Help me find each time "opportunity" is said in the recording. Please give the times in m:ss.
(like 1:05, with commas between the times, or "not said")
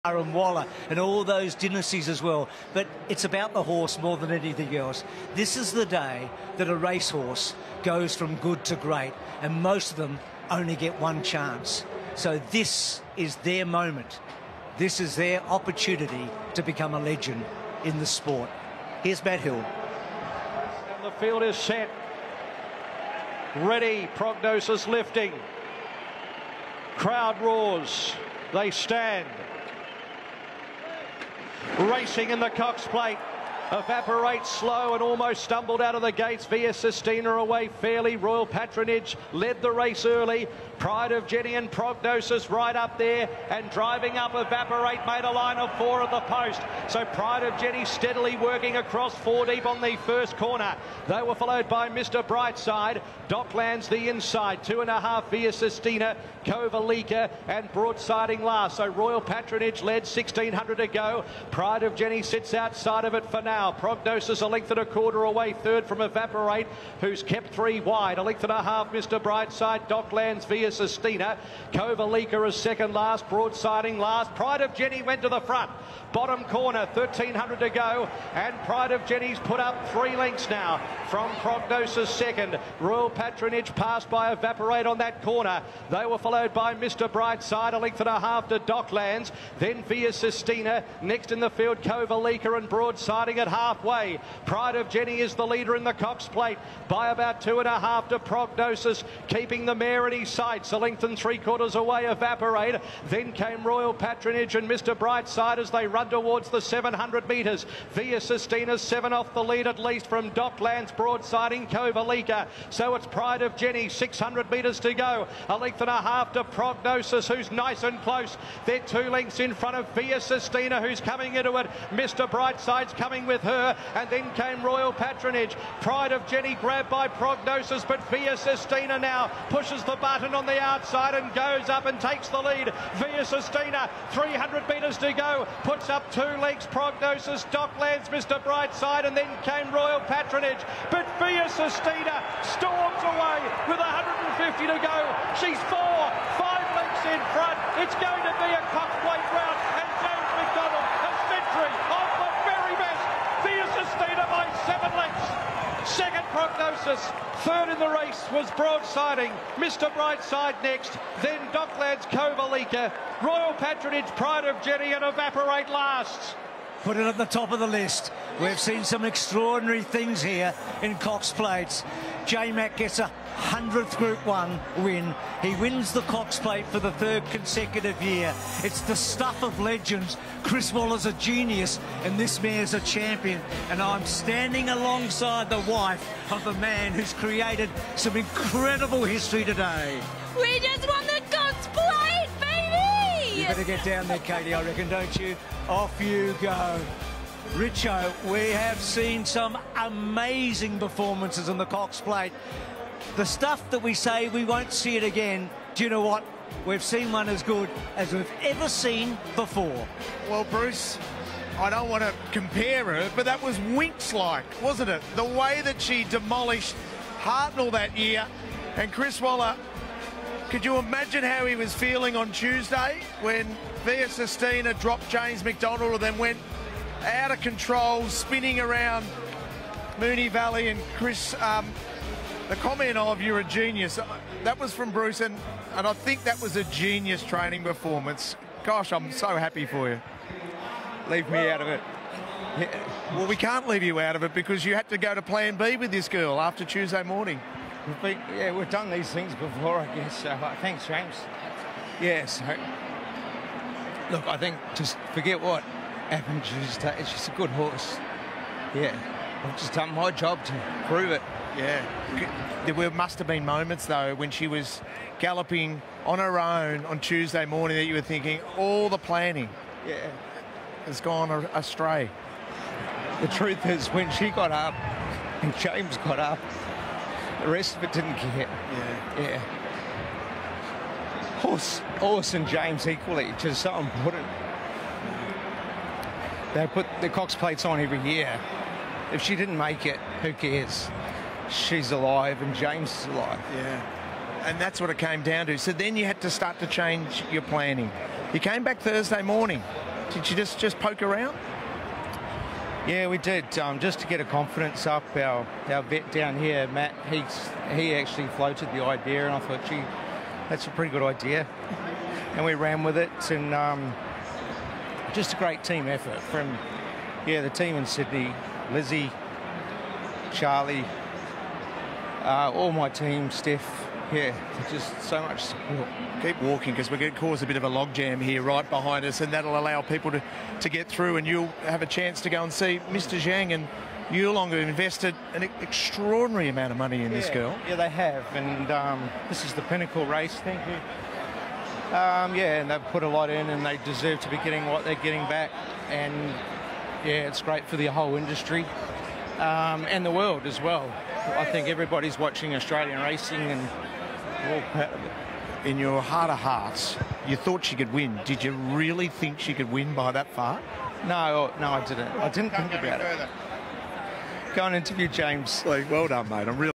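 0:15.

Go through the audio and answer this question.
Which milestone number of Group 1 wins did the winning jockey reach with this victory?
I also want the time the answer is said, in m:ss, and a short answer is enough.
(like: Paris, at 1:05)
100th, at 2:53.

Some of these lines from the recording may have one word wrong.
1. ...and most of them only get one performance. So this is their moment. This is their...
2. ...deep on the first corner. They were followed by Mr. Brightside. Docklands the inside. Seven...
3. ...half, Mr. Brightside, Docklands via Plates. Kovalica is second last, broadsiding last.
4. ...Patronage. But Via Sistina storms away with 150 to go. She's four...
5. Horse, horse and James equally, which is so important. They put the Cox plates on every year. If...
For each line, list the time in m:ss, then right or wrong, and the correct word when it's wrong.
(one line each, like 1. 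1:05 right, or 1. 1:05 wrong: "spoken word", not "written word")
1. 0:09 wrong: "chance", not "performance"
2. 0:49 wrong: "Two", not "Seven"
3. 1:08 wrong: "Sistina", not "Plates"
4. 2:20 right
5. 4:41 right.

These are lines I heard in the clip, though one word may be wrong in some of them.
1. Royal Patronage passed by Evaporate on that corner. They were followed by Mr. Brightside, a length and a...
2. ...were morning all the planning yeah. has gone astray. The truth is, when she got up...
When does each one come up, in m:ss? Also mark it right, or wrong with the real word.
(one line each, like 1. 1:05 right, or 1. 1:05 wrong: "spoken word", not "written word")
1. 1:22 right
2. 4:27 wrong: "thinking", not "morning".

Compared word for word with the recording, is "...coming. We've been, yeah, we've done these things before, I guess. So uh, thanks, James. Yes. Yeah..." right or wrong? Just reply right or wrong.
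wrong.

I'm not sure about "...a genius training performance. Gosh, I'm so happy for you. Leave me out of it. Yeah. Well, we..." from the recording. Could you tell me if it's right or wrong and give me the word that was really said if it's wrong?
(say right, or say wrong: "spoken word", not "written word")
right.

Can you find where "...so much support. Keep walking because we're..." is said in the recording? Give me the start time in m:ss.
5:25.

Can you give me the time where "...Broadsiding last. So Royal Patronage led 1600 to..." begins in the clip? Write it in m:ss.
0:57.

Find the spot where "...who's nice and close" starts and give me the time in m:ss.
1:57.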